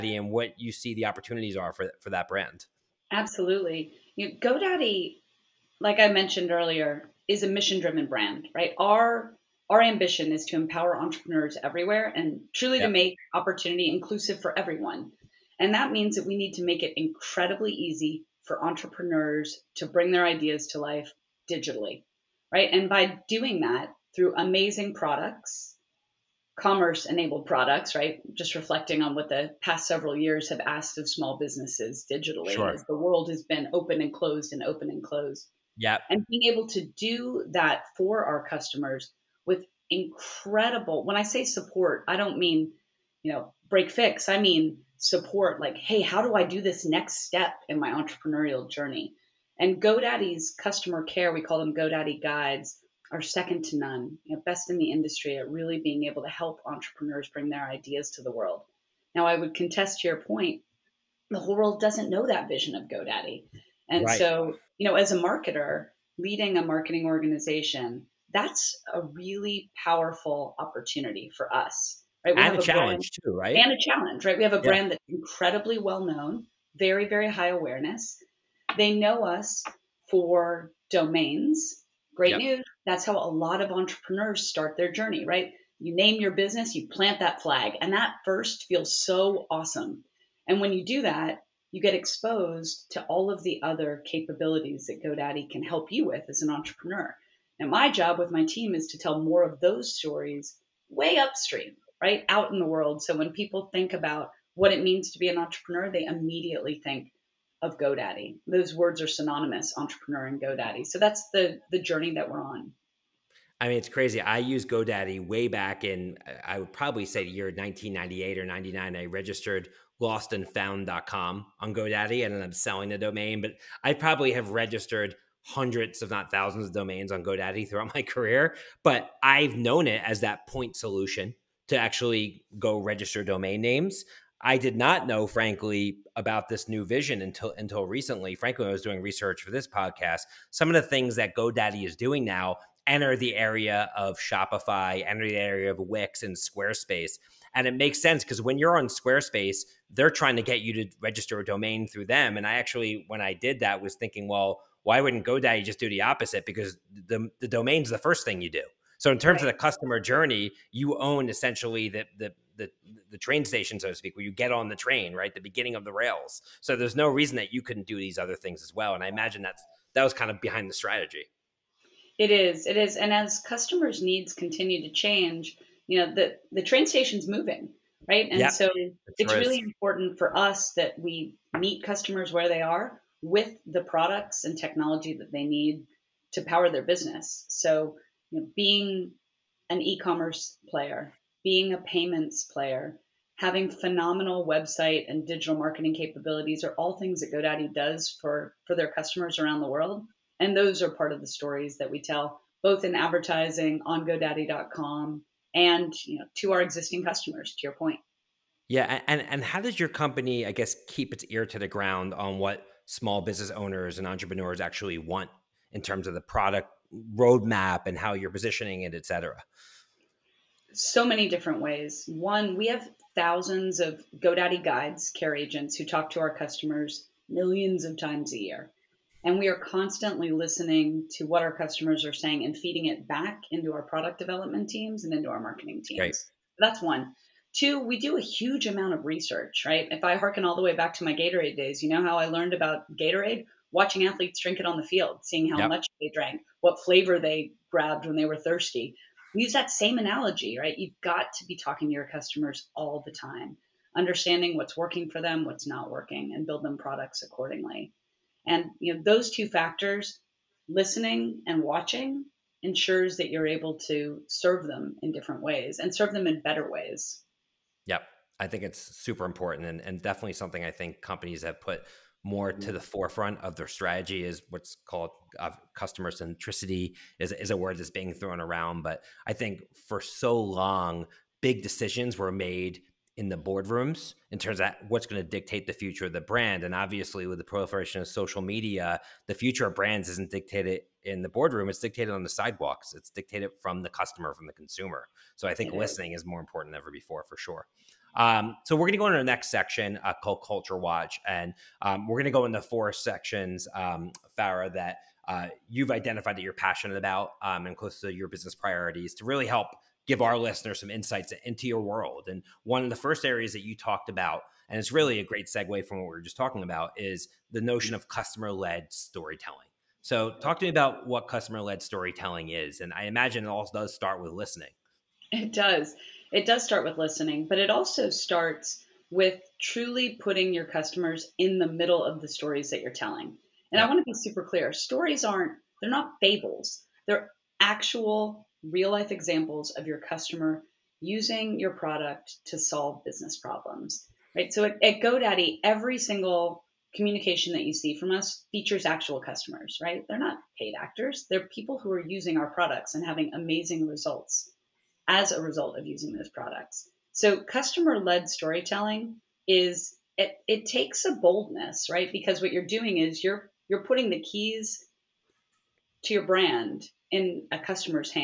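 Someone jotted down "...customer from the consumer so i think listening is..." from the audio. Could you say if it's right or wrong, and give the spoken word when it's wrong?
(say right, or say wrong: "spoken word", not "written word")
right.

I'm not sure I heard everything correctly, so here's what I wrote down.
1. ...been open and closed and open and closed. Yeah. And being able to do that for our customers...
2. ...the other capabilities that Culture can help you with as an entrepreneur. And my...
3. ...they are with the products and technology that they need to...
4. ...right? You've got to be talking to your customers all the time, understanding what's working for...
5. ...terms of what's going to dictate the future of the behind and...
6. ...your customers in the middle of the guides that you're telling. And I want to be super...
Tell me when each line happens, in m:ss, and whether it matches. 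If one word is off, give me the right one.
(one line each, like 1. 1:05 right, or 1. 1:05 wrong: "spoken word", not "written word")
1. 0:33 right
2. 1:33 wrong: "GoDaddy", not "Culture"
3. 3:02 right
4. 4:10 right
5. 4:44 wrong: "brand", not "behind"
6. 5:30 wrong: "stories", not "guides".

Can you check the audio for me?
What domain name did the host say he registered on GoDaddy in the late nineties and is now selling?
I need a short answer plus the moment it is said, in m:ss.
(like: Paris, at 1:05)
lostandfound.com, at 2:00.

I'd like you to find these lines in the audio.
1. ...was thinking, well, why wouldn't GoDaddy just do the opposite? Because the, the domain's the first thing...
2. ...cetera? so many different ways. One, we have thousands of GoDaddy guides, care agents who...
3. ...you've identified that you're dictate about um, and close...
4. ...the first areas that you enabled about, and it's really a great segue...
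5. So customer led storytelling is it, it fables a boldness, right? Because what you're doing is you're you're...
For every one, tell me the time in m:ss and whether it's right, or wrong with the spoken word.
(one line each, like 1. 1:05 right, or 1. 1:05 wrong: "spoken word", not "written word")
1. 2:33 right
2. 3:39 right
3. 5:05 wrong: "passionate", not "dictate"
4. 5:12 wrong: "talked", not "enabled"
5. 5:57 wrong: "takes", not "fables".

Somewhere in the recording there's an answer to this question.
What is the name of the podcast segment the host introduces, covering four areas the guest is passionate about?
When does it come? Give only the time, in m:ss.
5:00.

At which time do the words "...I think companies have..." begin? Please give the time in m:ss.
4:30.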